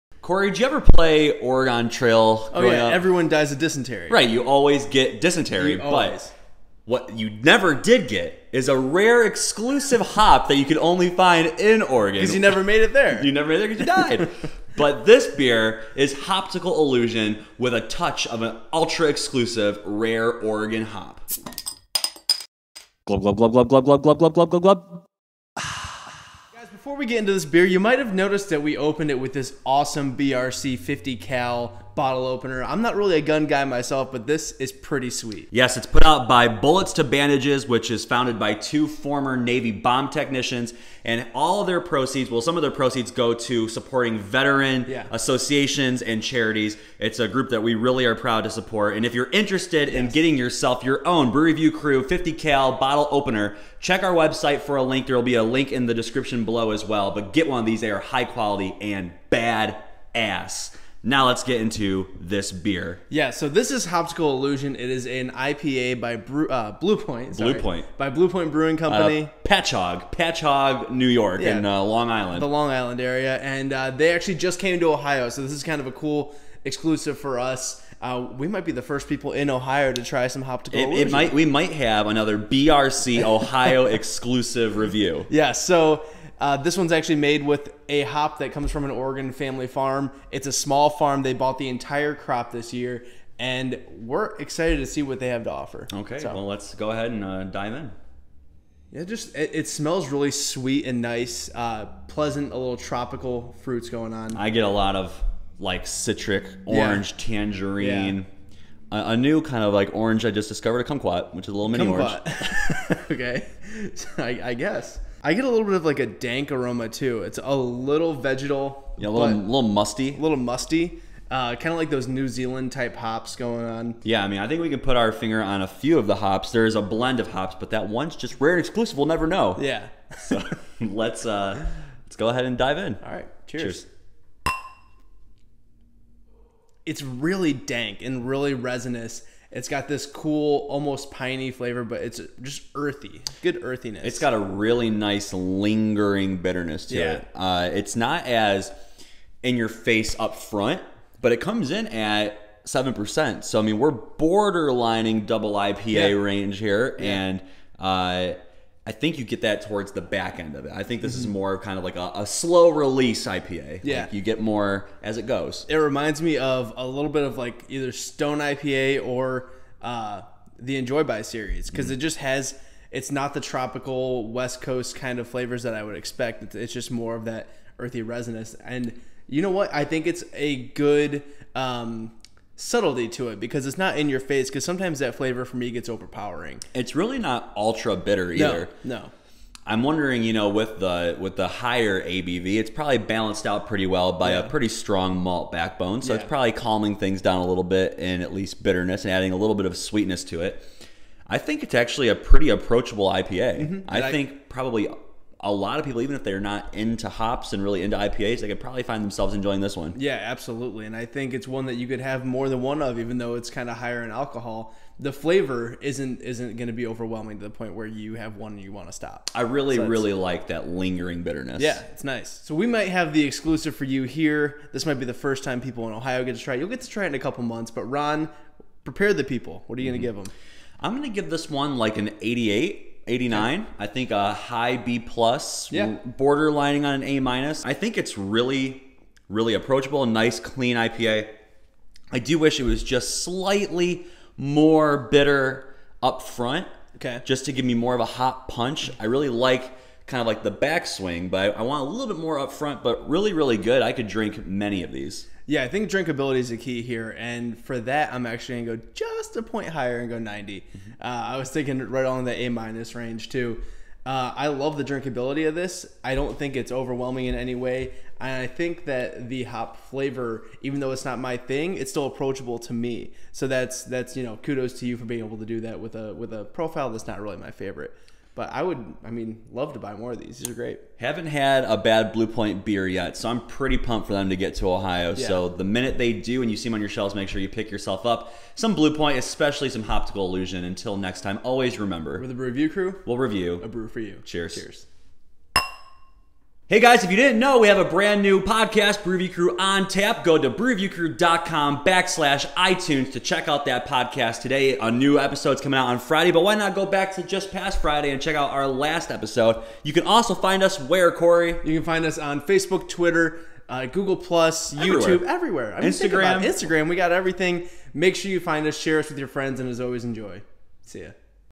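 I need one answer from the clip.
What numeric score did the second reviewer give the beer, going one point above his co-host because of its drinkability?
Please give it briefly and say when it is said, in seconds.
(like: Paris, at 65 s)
90, at 260 s.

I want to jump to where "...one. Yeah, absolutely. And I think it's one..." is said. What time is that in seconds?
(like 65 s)
209 s.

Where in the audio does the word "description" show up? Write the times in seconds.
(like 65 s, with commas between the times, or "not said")
55 s.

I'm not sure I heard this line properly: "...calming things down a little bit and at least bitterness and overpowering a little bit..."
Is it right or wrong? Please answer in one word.
wrong.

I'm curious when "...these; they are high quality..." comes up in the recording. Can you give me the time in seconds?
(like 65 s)
57 s.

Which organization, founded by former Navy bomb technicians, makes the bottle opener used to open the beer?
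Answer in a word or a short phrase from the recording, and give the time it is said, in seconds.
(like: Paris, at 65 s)
Bullets to Bandages, at 36 s.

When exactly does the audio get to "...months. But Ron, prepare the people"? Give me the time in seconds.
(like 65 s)
227 s.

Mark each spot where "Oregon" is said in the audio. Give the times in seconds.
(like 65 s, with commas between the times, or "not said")
1 s, 11 s, 20 s, 88 s.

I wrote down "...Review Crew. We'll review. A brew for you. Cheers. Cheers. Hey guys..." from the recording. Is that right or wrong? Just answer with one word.
right.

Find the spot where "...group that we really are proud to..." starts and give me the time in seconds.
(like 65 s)
47 s.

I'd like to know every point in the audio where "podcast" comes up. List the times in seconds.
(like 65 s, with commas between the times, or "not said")
298 s, 303 s.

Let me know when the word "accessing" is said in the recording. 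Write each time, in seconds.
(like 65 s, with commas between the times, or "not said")
not said.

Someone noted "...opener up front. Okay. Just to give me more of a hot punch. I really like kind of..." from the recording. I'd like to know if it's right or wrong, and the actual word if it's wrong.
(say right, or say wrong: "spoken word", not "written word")
wrong: "bitter", not "opener".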